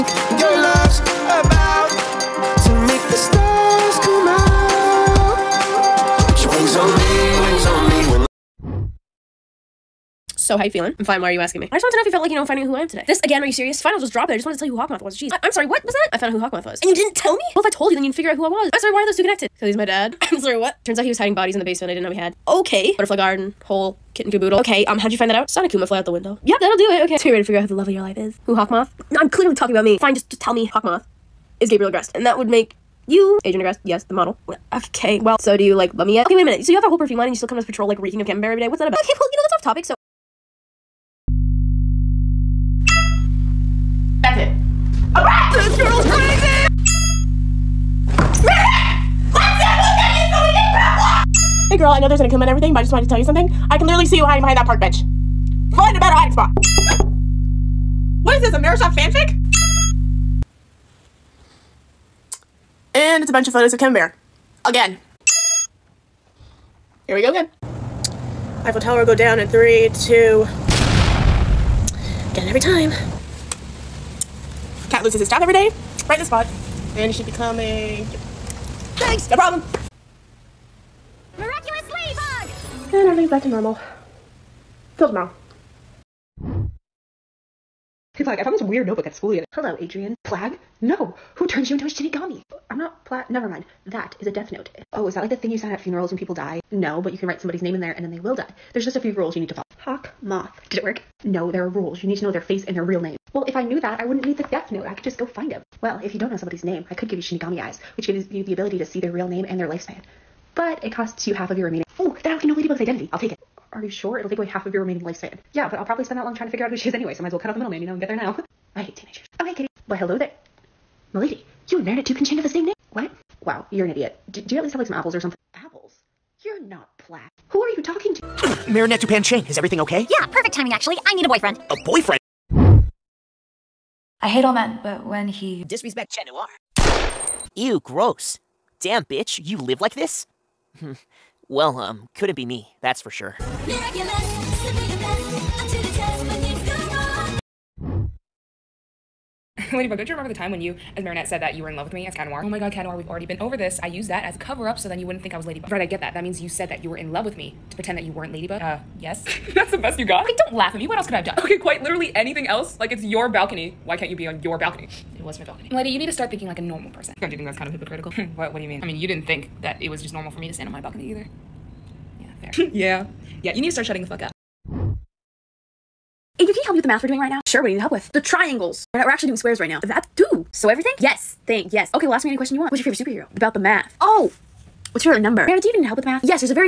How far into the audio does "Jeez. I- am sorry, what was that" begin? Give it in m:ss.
0:15.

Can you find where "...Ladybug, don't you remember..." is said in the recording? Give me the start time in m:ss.
2:29.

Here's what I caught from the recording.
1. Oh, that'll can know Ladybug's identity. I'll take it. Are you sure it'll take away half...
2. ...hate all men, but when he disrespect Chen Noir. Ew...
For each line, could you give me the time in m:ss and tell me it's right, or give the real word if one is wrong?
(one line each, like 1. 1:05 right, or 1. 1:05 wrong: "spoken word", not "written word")
1. 1:51 right
2. 2:14 right.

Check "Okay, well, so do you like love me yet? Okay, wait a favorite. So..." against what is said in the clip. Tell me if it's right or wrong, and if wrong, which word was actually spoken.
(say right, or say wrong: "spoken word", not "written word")
wrong: "minute", not "favorite".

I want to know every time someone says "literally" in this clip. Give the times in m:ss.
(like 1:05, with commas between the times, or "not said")
0:53, 2:41.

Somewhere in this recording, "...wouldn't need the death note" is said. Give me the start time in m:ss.
1:44.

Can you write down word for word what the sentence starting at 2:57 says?
Sure, what do you need help with?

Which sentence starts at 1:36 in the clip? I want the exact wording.
No, but you can write somebody's name in there and then they will die.